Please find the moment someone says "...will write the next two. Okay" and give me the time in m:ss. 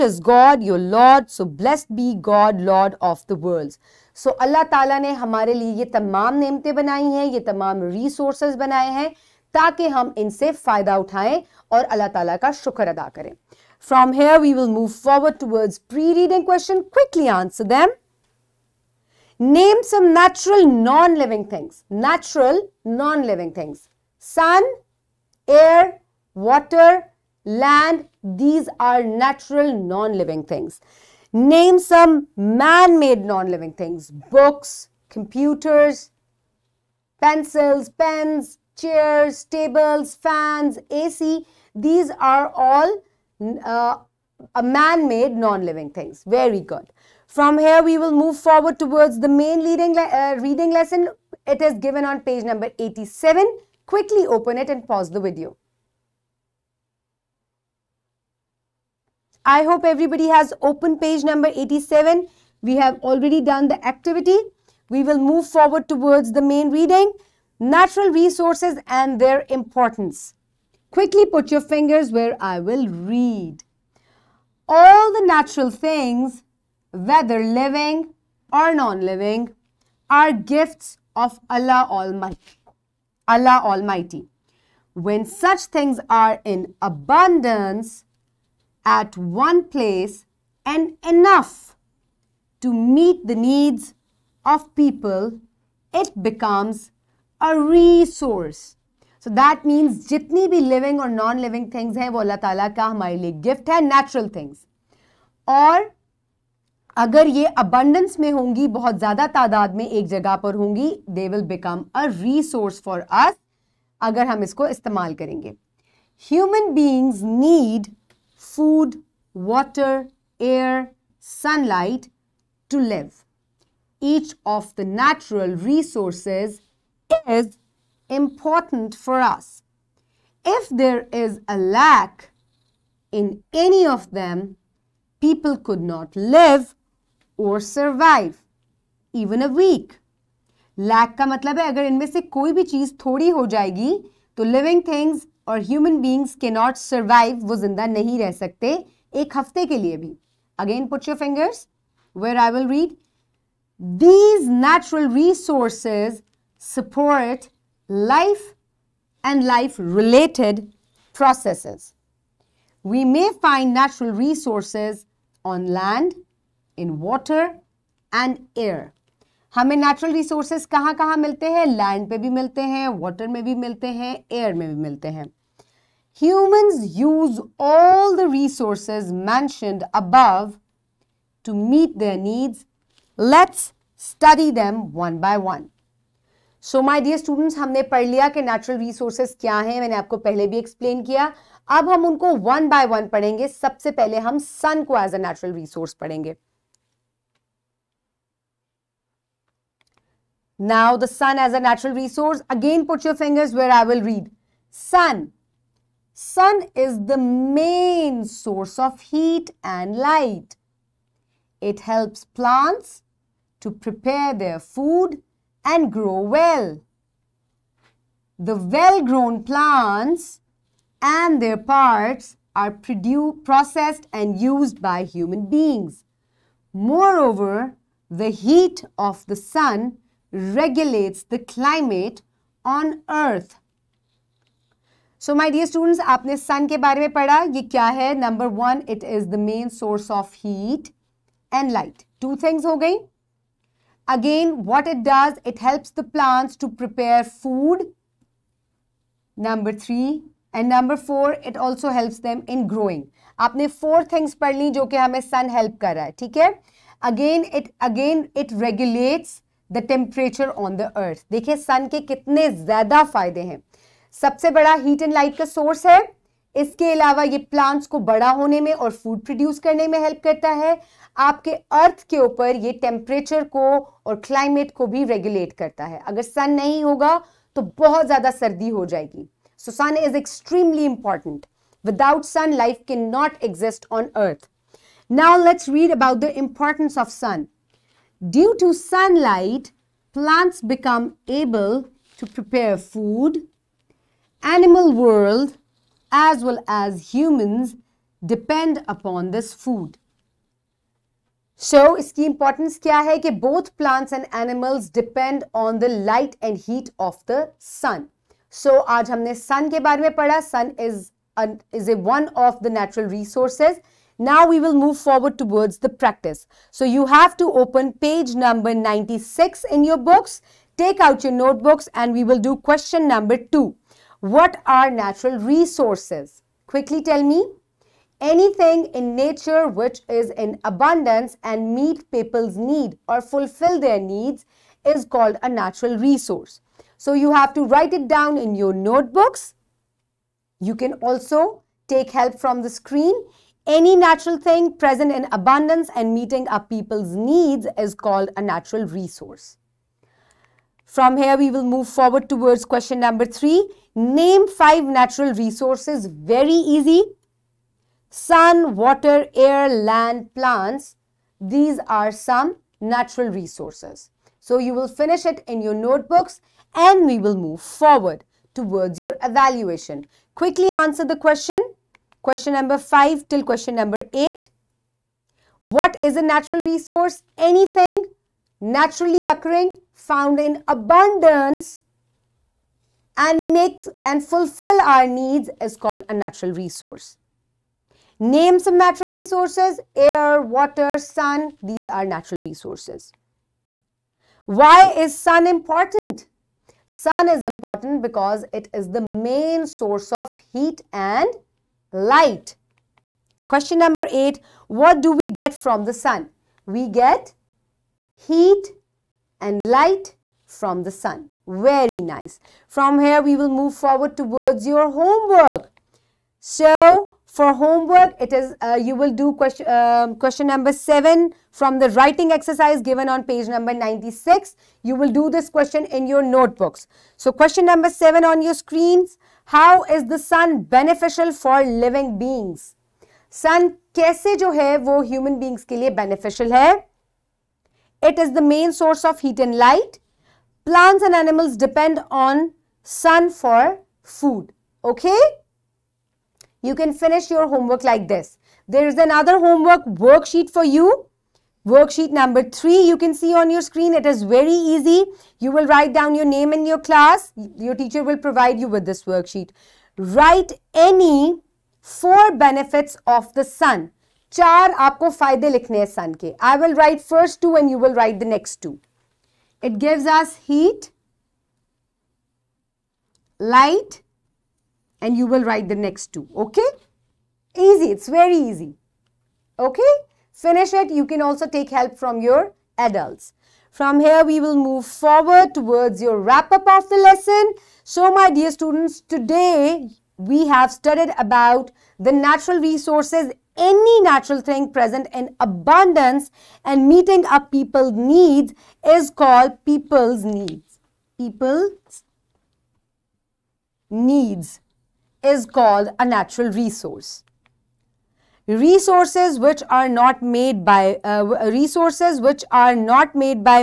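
7:55.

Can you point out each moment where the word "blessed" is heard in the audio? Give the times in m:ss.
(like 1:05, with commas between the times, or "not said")
0:01.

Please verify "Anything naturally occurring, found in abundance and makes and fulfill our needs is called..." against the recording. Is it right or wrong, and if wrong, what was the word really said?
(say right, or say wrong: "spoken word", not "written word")
right.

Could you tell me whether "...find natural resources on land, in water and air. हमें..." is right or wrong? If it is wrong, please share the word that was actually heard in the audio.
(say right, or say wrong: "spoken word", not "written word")
right.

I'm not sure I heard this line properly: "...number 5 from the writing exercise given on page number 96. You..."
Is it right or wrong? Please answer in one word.
wrong.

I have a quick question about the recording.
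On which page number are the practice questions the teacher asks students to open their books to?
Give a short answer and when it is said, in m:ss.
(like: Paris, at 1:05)
96, at 5:18.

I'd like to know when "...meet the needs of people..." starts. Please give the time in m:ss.
1:32.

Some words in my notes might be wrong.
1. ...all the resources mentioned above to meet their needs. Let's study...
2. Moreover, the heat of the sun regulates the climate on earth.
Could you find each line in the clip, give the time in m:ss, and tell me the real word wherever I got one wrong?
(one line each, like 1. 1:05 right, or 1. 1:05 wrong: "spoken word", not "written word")
1. 2:57 right
2. 3:46 right.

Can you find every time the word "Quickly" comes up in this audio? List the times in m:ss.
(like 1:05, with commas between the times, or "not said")
0:16, 0:53, 1:10, 6:10.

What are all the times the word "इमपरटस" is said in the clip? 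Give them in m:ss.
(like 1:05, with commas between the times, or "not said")
4:46.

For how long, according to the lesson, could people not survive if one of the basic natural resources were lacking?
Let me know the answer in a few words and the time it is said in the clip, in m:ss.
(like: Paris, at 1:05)
a week, at 2:19.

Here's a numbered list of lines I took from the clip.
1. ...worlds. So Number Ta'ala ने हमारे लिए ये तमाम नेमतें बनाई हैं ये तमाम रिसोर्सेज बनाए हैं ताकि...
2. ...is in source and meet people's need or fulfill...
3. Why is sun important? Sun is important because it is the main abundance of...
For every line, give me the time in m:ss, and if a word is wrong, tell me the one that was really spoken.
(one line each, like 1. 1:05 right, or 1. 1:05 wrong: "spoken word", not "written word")
1. 0:03 wrong: "Allah", not "Number"
2. 5:30 wrong: "abundance", not "source"
3. 6:34 wrong: "source", not "abundance".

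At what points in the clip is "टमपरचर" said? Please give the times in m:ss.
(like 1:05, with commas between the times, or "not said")
4:19, 4:32.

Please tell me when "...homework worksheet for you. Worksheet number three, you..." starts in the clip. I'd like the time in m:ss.
7:29.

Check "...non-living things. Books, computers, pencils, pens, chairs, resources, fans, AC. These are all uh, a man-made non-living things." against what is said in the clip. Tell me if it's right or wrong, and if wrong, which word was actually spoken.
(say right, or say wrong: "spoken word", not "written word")
wrong: "tables", not "resources".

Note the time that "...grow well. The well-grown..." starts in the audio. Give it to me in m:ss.
3:35.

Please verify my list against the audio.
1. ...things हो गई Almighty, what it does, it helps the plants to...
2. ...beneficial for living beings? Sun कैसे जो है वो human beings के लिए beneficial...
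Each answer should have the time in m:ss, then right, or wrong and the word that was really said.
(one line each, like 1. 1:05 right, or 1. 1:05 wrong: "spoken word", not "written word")
1. 4:02 wrong: "Again", not "Almighty"
2. 7:10 right.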